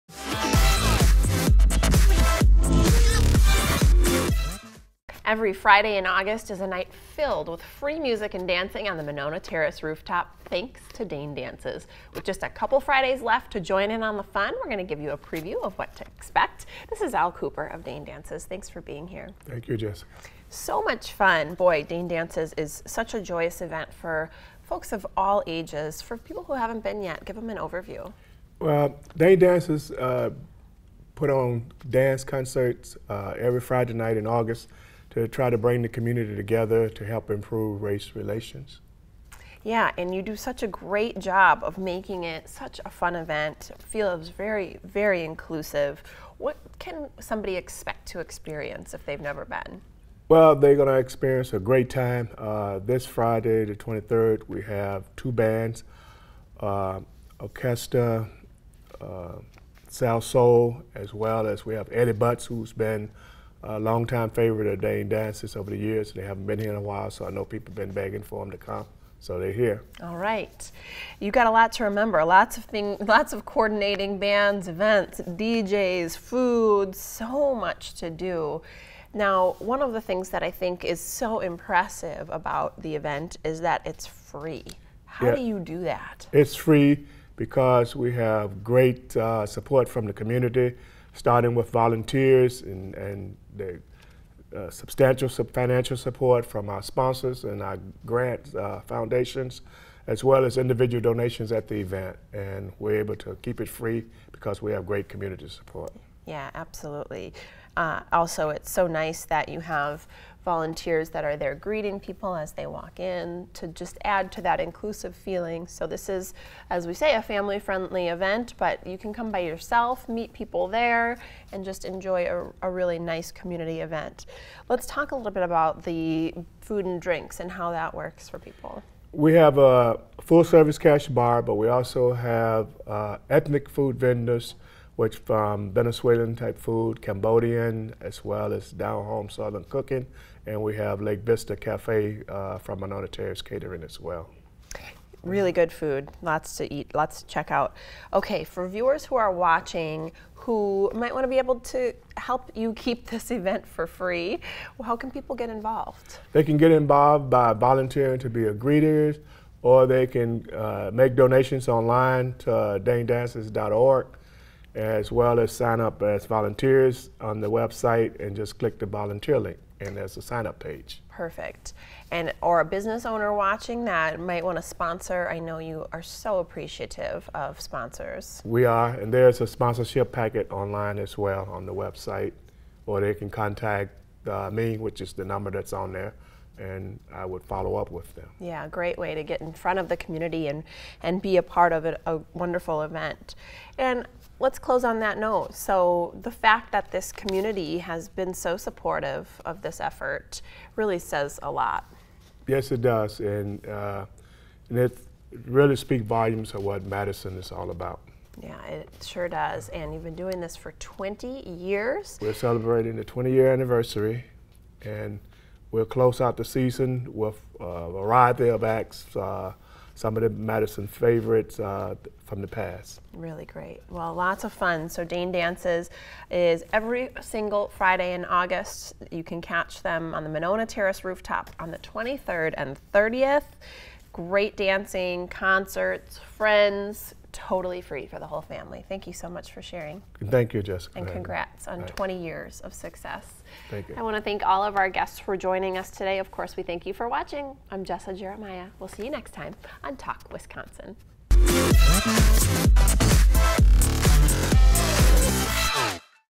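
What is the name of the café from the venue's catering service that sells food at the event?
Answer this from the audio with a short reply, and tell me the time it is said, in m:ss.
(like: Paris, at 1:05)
Lake Vista Cafe, at 2:21.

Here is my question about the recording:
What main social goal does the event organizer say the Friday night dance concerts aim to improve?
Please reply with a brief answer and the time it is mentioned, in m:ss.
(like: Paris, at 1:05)
Race relations, at 0:37.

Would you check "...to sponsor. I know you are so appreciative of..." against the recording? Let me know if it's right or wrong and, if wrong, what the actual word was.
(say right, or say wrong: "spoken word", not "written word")
right.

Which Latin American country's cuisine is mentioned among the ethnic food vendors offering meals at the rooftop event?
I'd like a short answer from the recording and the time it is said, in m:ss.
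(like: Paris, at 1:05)
Venezuelan, at 2:15.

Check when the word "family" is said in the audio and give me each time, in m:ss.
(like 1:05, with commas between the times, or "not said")
1:57, 3:58.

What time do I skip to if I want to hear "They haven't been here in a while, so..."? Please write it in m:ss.
1:06.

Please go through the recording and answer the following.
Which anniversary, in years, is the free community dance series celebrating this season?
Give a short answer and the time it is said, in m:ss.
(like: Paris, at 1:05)
20, at 3:33.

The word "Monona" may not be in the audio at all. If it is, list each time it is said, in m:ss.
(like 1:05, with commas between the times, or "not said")
0:09, 2:22, 3:50.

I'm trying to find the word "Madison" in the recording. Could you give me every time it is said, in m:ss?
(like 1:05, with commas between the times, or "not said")
3:26, 3:40.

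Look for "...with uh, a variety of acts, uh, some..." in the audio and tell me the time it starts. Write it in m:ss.
3:37.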